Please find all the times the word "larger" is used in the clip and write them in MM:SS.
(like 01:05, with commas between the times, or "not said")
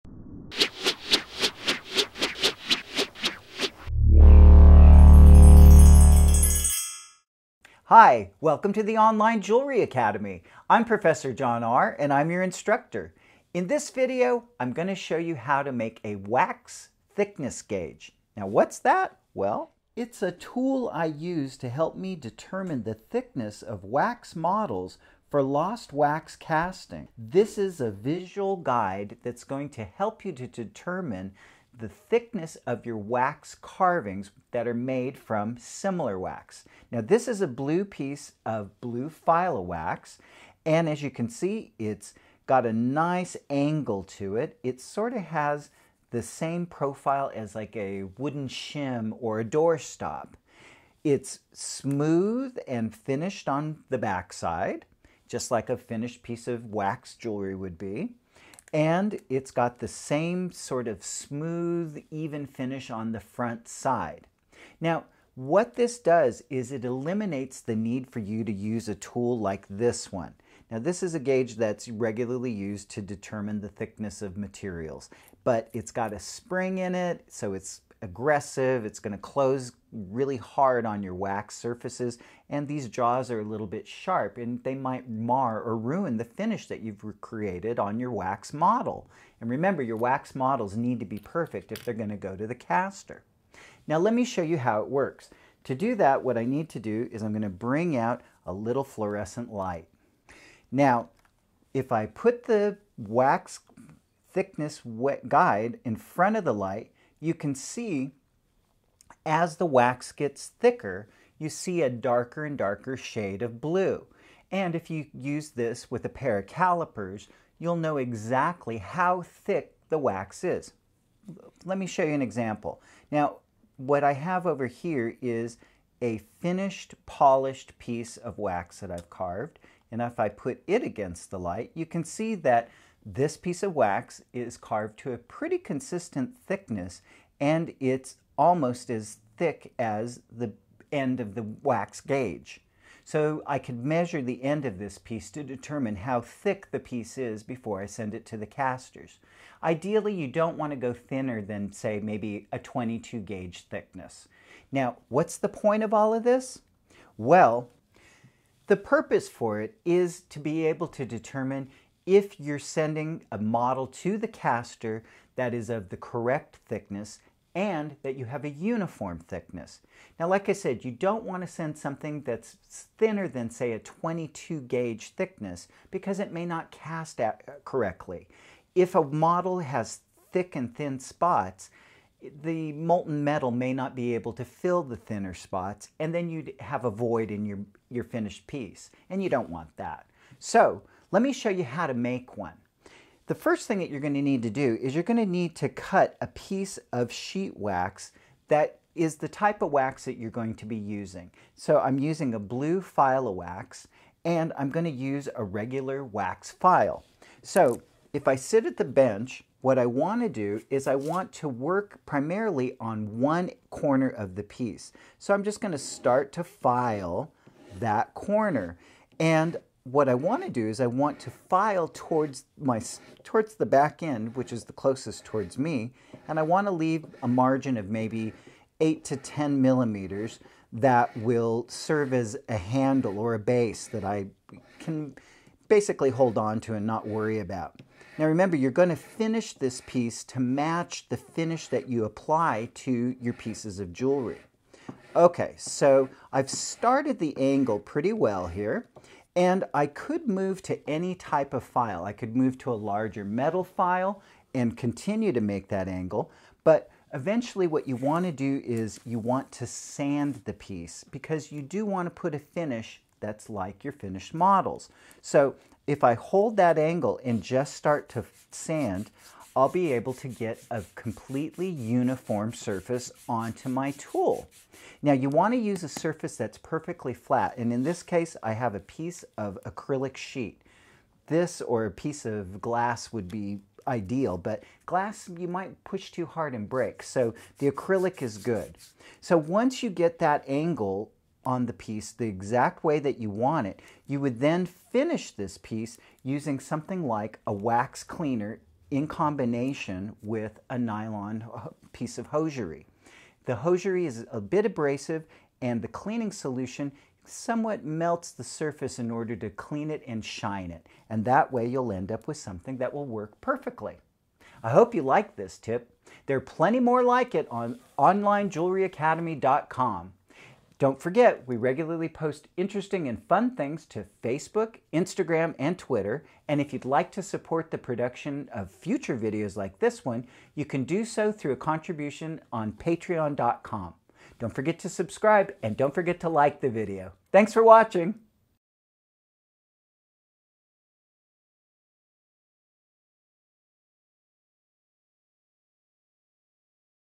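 04:12.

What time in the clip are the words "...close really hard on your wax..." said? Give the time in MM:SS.
01:19.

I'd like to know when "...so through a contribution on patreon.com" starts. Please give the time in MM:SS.
05:31.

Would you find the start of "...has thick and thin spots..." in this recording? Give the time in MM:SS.
02:59.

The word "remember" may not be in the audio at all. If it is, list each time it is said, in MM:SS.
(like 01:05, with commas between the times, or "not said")
01:29, 03:58.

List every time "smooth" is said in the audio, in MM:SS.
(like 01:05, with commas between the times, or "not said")
00:51, 01:01.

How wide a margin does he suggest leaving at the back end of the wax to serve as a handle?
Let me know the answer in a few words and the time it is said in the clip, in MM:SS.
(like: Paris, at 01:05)
8 to 10 millimeters, at 03:48.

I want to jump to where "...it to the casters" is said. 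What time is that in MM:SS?
02:28.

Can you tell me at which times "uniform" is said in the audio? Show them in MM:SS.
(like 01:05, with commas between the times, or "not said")
02:48, 04:31.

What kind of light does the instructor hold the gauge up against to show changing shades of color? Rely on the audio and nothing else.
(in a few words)
Fluorescent light.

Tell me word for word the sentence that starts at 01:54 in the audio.
And if you use this with a pair of calipers, you'll know exactly how thick the wax is.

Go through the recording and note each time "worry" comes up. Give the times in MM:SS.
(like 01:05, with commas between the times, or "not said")
03:57.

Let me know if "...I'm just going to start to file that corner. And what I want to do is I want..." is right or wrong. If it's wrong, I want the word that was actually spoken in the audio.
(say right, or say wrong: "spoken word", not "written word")
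right.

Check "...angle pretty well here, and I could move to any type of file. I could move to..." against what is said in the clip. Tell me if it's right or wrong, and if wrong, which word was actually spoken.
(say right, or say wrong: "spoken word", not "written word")
right.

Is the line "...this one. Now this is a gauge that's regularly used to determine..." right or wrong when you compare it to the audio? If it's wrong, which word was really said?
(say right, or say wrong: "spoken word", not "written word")
right.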